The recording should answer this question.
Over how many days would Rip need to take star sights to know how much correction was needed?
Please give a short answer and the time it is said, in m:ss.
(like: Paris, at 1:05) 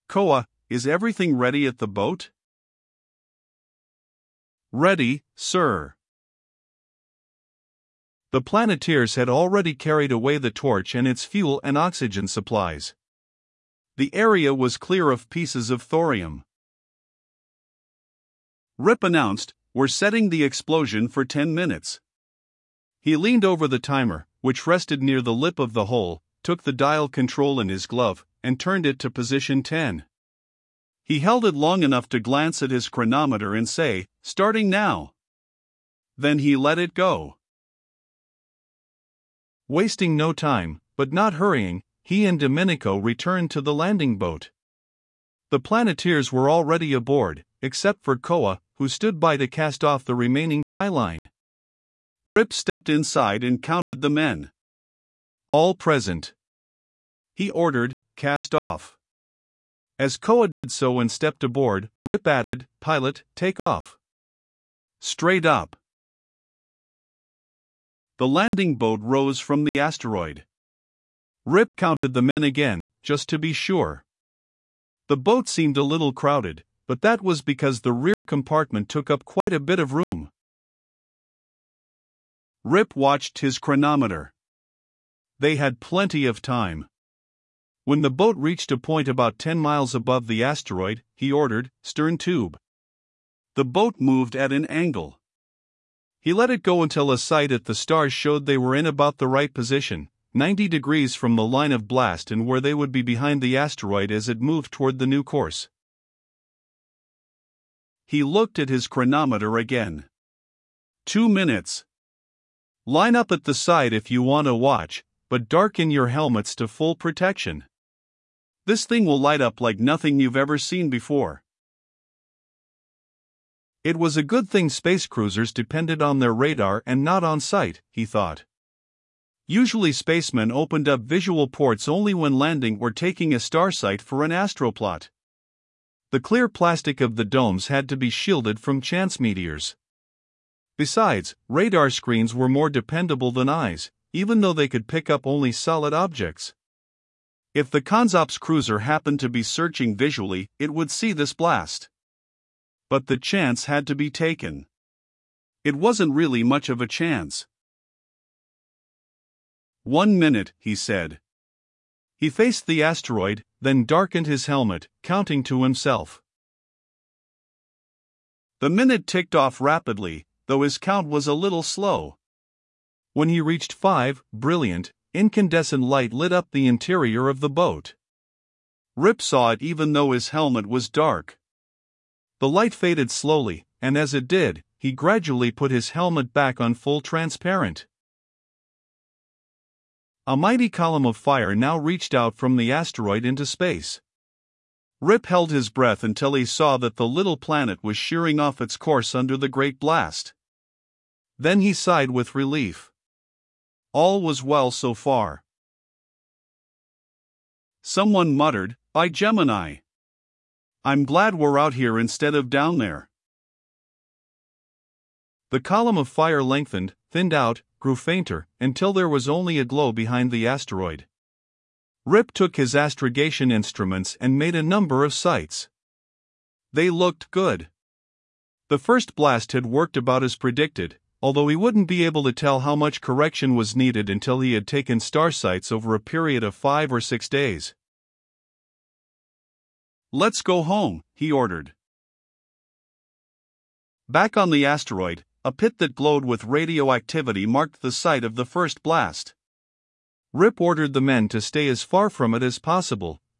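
5 or 6 days, at 3:56.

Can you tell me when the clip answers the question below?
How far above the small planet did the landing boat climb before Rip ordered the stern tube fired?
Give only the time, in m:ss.
1:29.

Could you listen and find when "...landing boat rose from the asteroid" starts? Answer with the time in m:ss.
1:08.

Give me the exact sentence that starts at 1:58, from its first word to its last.
This thing will light up like nothing you've ever seen before.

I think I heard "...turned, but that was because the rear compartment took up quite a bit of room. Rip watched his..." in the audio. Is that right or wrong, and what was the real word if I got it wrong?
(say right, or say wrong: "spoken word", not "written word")
wrong: "crowded", not "turned".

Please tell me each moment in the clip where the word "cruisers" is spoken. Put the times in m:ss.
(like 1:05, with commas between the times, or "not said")
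2:05, 2:28.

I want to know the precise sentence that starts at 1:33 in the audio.
The boat moved at an angle.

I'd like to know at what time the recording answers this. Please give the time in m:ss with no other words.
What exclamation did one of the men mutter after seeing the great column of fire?
3:28.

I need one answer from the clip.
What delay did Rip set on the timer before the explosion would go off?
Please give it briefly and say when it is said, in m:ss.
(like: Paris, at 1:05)
10 minutes, at 0:21.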